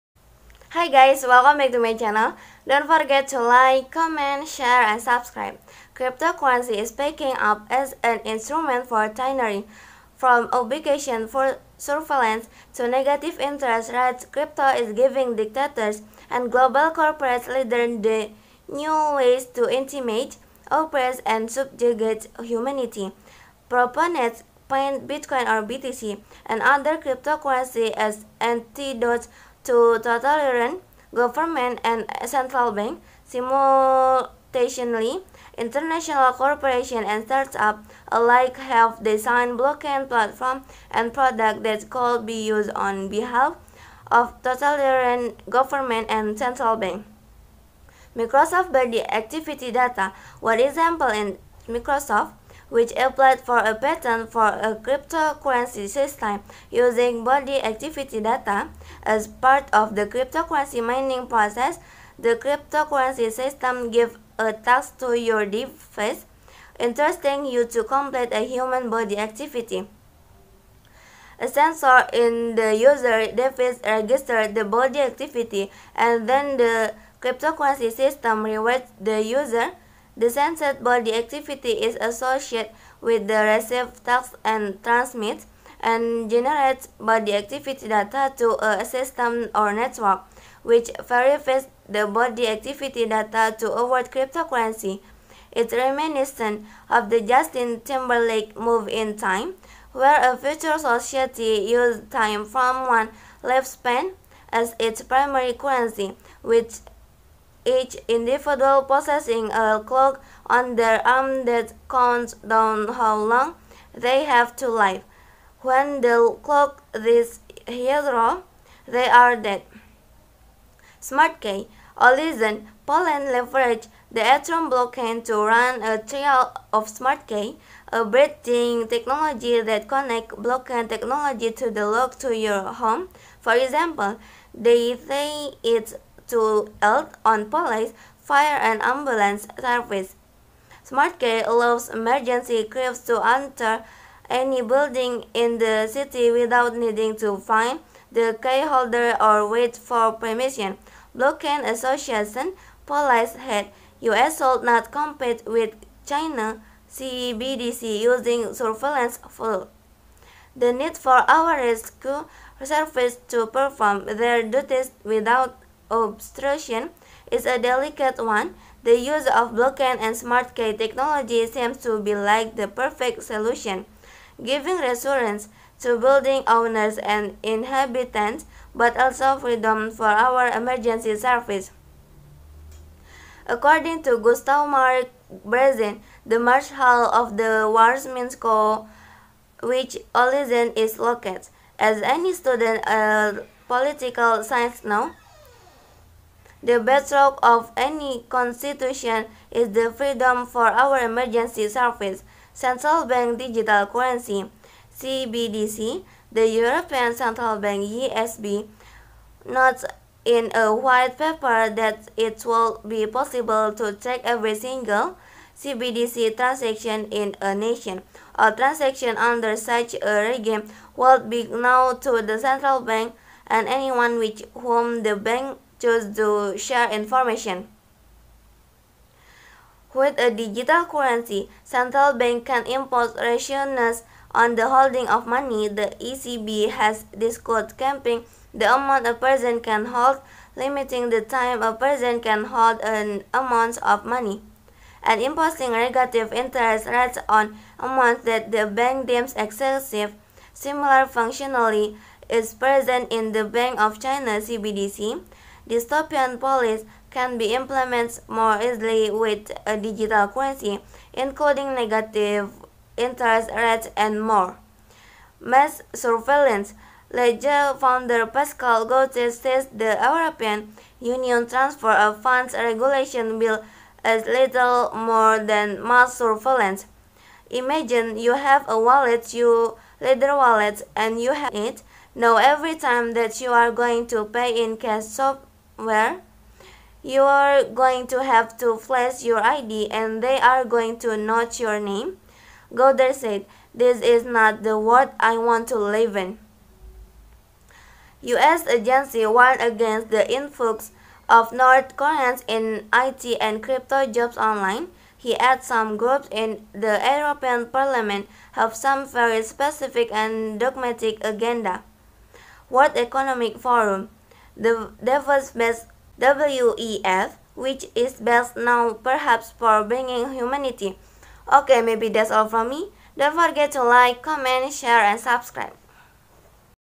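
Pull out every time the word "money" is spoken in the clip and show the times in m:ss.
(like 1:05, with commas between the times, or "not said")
3:55, 4:04.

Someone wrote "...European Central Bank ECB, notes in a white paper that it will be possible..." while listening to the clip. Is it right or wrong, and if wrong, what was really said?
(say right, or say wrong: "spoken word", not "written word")
right.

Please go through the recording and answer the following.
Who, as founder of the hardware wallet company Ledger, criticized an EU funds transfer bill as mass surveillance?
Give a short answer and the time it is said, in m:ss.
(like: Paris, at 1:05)
Pascal Gauthier, at 4:28.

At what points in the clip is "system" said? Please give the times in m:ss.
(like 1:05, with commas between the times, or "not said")
0:55, 1:03, 1:17, 1:28.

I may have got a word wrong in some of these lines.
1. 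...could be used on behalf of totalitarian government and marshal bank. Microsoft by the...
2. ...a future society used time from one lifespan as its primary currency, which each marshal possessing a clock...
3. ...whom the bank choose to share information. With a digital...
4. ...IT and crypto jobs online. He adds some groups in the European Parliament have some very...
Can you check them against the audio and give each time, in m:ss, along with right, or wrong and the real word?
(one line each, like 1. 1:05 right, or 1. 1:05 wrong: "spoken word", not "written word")
1. 0:41 wrong: "central", not "marshal"
2. 1:40 wrong: "individual", not "marshal"
3. 3:44 right
4. 5:02 right.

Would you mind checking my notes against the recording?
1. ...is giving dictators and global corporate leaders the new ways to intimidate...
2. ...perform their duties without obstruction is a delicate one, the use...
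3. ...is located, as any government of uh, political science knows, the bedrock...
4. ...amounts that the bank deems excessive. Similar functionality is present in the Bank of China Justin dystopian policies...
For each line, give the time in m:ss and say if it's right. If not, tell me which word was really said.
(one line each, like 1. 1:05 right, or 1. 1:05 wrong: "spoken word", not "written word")
1. 0:14 right
2. 2:43 right
3. 3:10 wrong: "student", not "government"
4. 4:07 wrong: "CBDC", not "Justin".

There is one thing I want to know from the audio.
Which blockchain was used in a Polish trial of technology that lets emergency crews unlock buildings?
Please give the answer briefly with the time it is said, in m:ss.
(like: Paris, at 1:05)
Atom, at 2:04.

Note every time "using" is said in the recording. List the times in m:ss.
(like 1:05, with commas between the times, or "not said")
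0:56, 2:38.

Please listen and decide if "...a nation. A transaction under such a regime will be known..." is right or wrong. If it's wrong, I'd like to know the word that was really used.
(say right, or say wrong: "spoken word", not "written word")
right.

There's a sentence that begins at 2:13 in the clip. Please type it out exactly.
For example, they say it's to help on police, fire and ambulance service.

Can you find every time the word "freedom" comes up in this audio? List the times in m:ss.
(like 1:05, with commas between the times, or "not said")
2:59, 3:19.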